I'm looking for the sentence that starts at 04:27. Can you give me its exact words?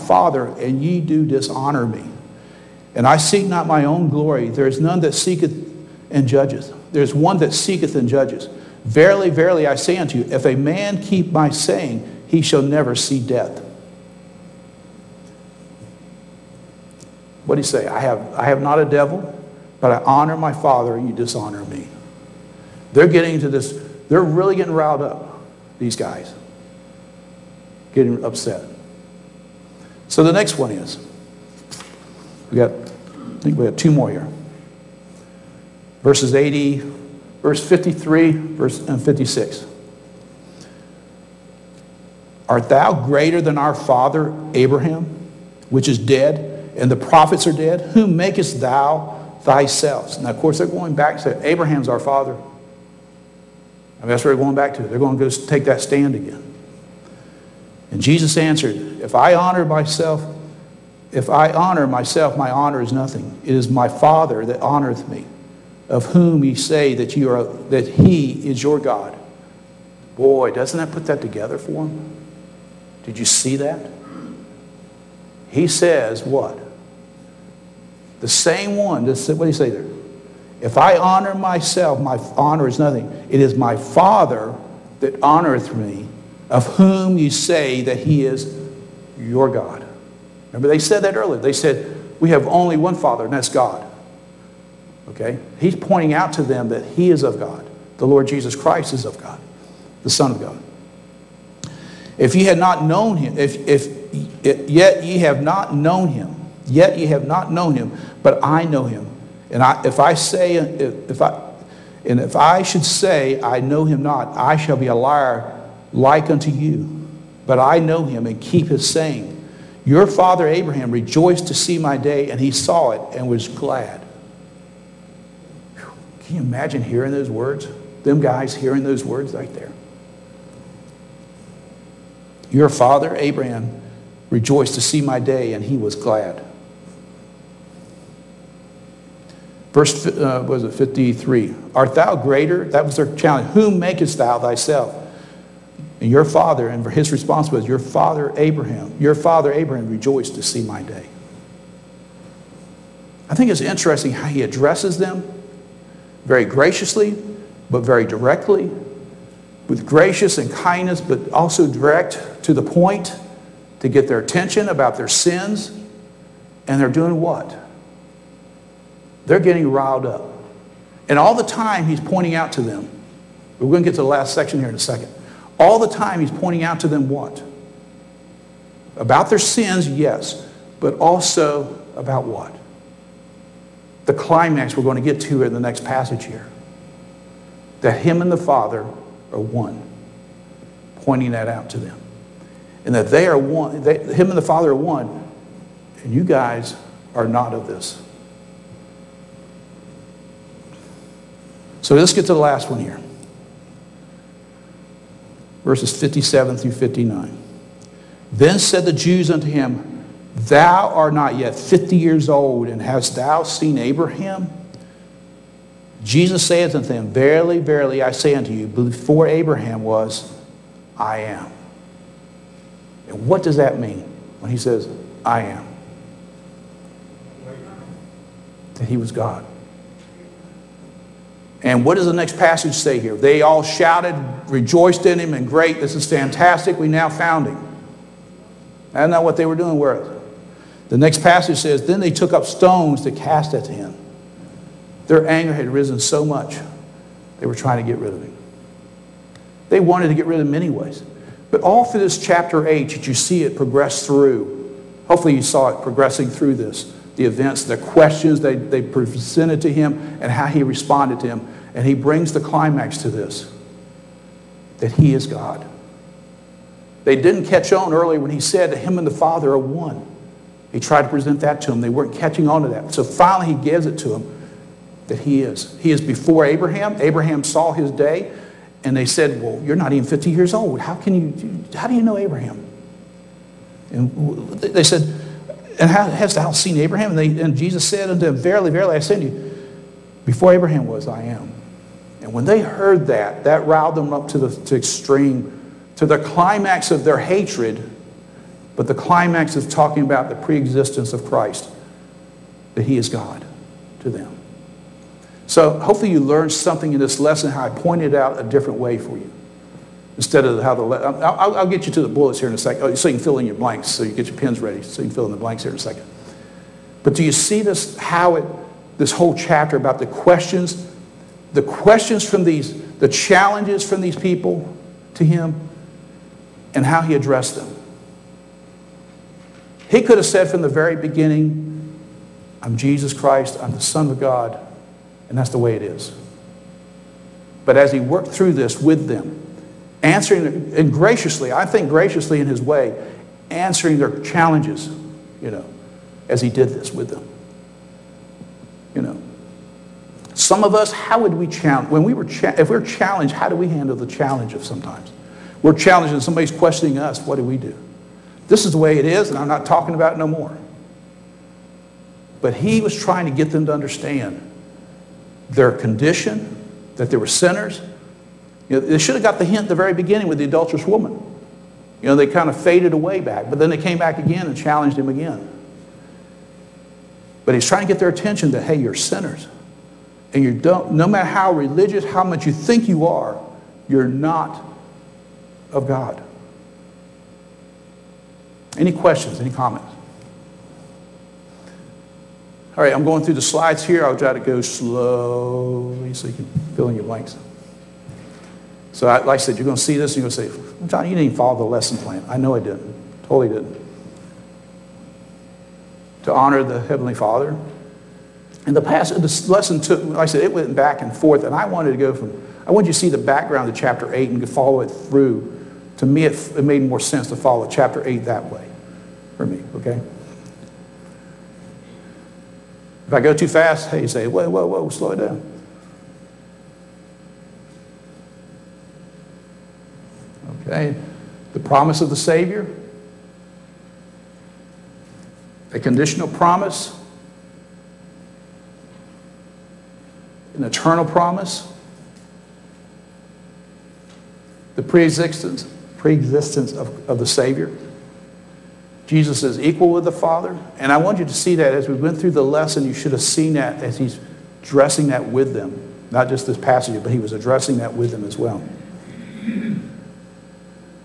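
They didn't catch on early when he said that him and the Father are one.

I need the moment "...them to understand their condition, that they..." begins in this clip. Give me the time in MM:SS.
06:03.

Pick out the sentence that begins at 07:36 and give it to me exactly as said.
Not just this passage, but he was addressing that with them as well.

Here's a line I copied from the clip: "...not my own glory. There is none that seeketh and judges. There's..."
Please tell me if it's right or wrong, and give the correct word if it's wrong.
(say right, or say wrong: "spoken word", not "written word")
right.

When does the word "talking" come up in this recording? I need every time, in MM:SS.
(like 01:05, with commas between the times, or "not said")
04:59, 05:59.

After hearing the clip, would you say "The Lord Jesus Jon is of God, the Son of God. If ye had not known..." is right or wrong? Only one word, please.
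wrong.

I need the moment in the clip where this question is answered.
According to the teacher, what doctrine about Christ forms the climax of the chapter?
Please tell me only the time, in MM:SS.
05:00.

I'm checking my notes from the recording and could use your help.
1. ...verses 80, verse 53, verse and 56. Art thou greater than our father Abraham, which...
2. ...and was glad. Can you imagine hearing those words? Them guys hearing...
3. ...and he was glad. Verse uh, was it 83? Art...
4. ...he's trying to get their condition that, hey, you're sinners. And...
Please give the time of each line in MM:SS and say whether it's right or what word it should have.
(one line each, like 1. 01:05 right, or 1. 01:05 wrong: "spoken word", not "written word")
1. 00:36 right
2. 02:03 right
3. 02:15 wrong: "53", not "83"
4. 06:17 wrong: "attention", not "condition".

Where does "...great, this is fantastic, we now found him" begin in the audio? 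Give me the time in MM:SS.
03:55.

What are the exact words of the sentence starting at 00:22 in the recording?
They're getting into this, they're really getting riled up, these guys.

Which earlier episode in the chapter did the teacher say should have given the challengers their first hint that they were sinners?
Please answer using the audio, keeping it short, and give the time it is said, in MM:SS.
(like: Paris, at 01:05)
the adulterous woman, at 06:10.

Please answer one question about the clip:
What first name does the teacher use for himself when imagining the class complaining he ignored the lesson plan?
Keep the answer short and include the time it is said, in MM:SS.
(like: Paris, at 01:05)
Jon, at 06:40.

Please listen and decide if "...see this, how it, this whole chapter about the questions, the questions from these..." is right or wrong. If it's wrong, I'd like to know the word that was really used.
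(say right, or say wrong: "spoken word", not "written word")
right.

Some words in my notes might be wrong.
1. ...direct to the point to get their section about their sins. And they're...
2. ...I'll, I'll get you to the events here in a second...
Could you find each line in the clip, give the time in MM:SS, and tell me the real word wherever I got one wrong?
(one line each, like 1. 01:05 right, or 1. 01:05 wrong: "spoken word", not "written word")
1. 02:41 wrong: "attention", not "section"
2. 05:10 wrong: "bullets", not "events".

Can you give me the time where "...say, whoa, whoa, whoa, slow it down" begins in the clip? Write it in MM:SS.
07:04.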